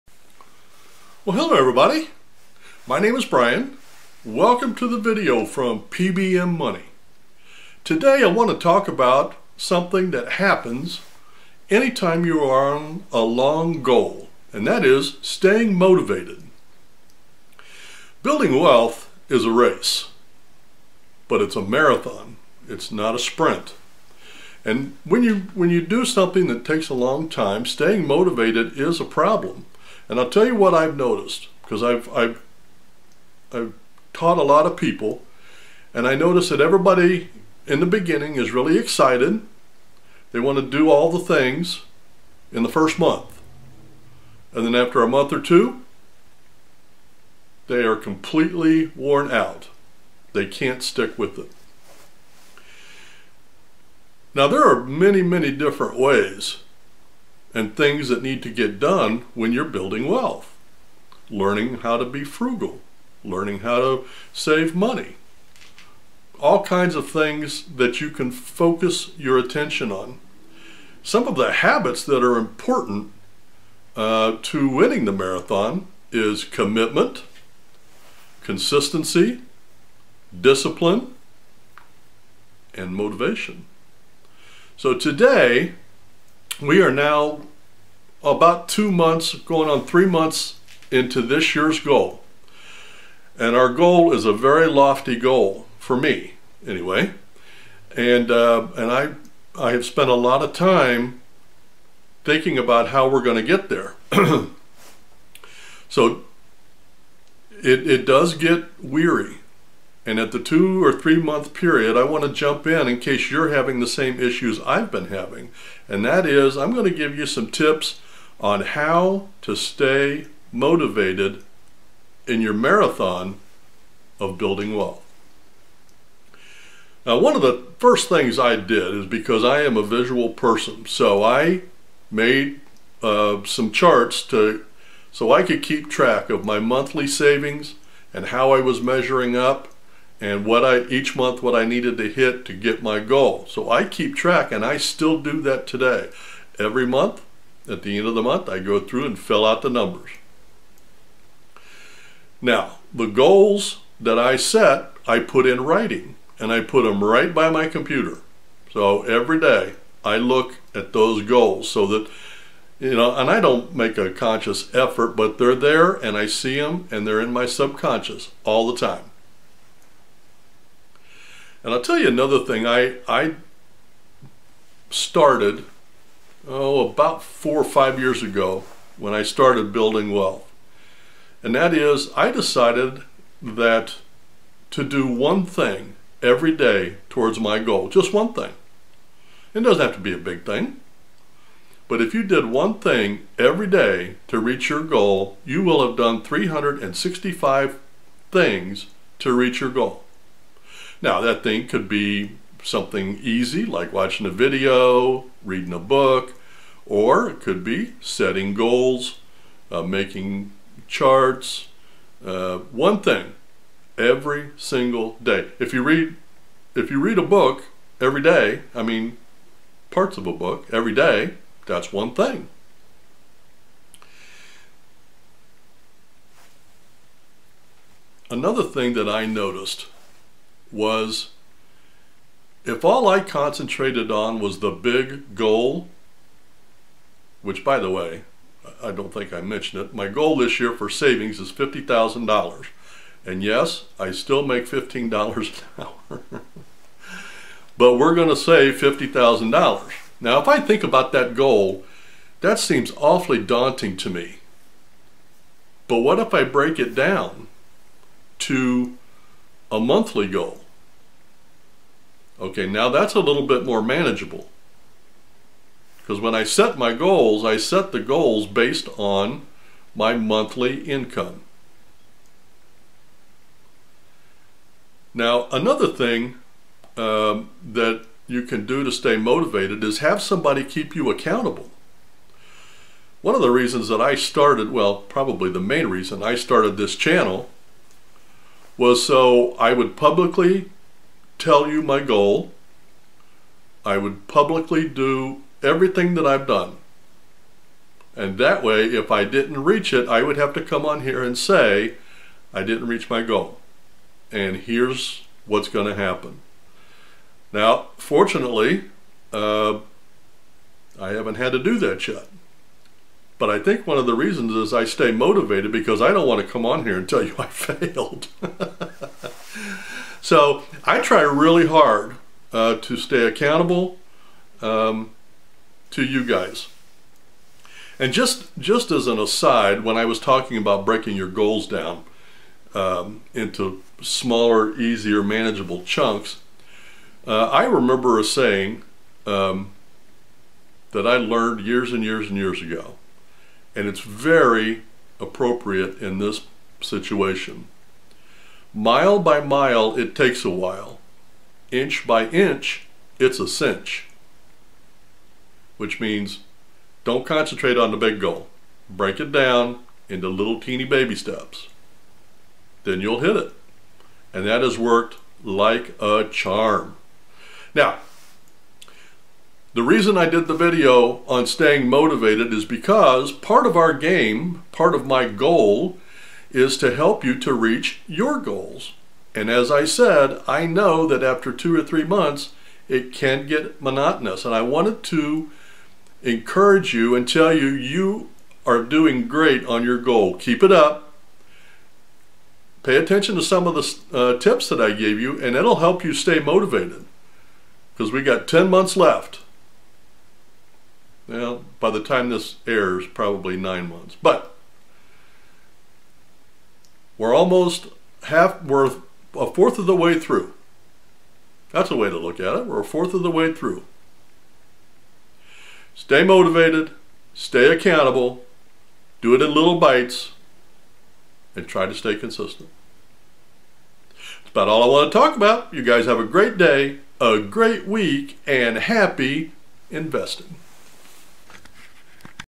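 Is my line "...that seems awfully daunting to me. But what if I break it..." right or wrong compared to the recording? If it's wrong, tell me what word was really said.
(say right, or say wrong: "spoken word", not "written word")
right.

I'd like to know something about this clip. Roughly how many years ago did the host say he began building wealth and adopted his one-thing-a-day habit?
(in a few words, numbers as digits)
4 or 5 years.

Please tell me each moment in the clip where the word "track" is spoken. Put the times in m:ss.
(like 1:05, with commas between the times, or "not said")
2:15, 2:24.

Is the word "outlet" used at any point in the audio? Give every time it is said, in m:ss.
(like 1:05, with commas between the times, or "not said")
not said.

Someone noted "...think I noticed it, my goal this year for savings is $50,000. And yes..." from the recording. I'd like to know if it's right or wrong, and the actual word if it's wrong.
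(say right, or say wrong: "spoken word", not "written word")
wrong: "mentioned", not "noticed".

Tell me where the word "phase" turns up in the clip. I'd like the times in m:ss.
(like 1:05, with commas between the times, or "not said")
not said.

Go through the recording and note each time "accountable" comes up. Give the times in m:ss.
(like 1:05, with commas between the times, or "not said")
4:41, 5:23, 6:57.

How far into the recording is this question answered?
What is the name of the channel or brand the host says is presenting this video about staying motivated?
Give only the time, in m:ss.
0:05.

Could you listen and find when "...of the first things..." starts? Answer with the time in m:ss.
2:07.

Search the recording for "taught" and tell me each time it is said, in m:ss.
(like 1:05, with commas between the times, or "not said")
0:34.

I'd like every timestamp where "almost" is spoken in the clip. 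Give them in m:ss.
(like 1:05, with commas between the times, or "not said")
6:47.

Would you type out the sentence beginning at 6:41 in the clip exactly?
Well, by the time this airs, probably nine months.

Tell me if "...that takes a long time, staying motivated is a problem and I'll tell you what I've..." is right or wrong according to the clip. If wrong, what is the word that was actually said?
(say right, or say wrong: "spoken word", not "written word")
right.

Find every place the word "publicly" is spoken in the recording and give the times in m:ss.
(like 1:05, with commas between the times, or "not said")
4:49, 4:54.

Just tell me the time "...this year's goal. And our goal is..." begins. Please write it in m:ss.
1:31.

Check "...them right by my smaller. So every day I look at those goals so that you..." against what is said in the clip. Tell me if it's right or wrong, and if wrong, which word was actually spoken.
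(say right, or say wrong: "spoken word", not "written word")
wrong: "computer", not "smaller".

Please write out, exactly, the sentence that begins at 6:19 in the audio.
And as I said, I know that after two or three months, it can get monotonous.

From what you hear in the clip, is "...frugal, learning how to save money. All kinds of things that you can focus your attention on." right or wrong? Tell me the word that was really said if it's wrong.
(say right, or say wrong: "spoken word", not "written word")
right.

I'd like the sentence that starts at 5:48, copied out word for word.
Mile by mile, it takes a while.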